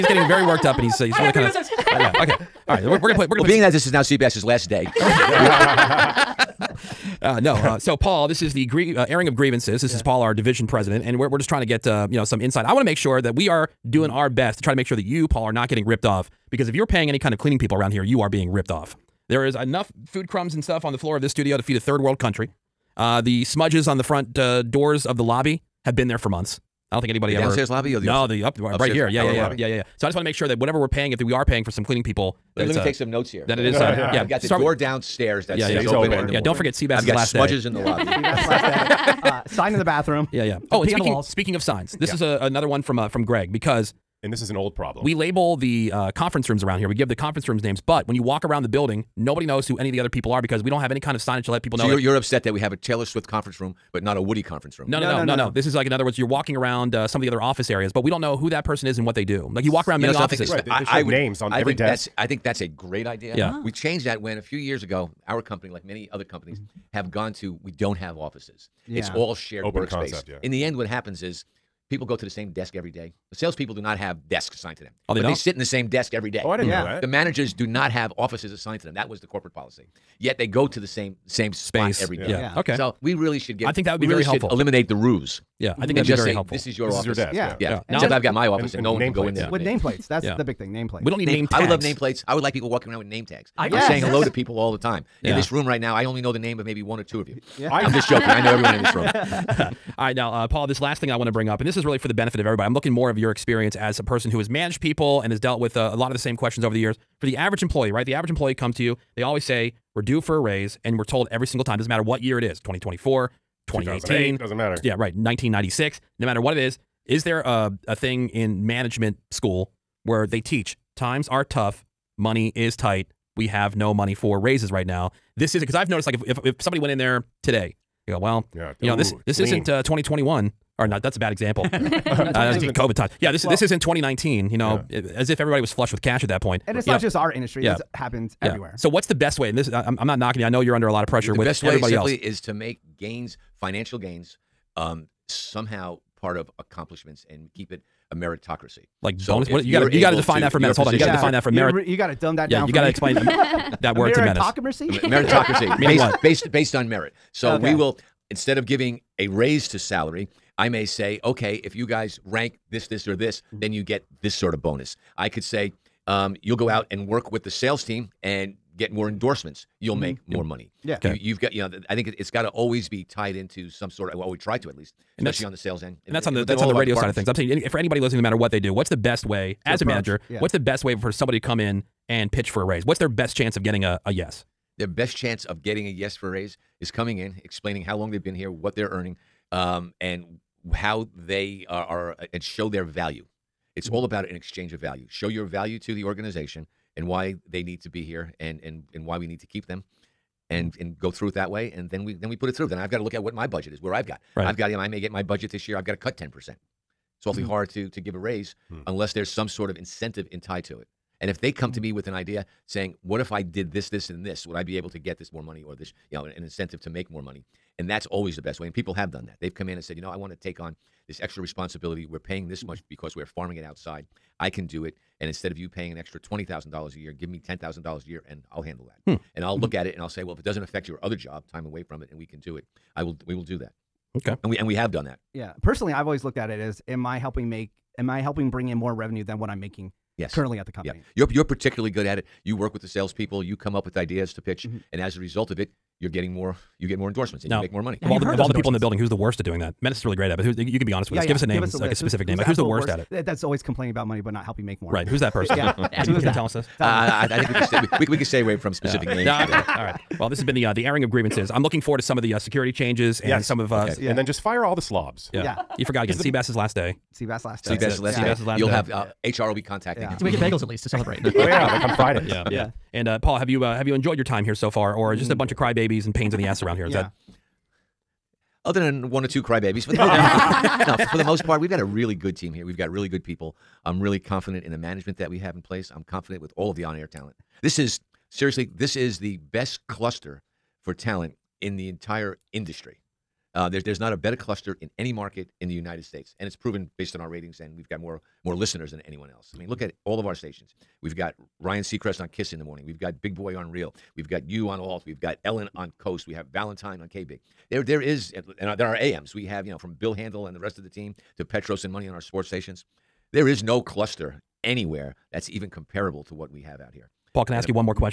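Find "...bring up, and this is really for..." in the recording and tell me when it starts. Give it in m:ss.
1:41.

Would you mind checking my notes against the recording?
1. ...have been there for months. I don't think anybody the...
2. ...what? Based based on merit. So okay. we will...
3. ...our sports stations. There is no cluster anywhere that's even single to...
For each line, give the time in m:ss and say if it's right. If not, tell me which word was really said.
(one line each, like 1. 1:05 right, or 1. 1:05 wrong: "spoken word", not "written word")
1. 0:25 right
2. 2:35 right
3. 5:12 wrong: "comparable", not "single".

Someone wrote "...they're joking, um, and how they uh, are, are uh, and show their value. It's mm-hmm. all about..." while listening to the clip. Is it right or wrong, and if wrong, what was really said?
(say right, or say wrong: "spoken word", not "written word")
wrong: "earning", not "joking".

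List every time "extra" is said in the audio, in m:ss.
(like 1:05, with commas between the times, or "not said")
3:41, 3:45.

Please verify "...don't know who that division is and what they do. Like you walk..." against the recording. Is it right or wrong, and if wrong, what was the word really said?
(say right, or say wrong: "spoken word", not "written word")
wrong: "person", not "division".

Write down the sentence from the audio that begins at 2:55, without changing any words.
And especially on the sales end, and that's on the that's on the radio side of things.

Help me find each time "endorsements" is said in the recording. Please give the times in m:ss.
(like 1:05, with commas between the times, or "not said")
2:49, 4:07.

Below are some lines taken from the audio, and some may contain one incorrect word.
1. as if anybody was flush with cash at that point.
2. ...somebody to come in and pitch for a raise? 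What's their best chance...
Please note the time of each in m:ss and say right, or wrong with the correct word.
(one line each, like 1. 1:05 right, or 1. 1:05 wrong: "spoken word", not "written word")
1. 2:14 wrong: "everybody", not "anybody"
2. 3:01 right.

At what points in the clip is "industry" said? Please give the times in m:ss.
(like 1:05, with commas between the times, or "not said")
2:17, 4:52.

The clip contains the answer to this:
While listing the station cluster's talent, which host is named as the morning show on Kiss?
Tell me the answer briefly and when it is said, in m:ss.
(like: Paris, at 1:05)
Ryan Seacrest, at 5:01.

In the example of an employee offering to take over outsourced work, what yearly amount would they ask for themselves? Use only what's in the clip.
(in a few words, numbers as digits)
$10,000.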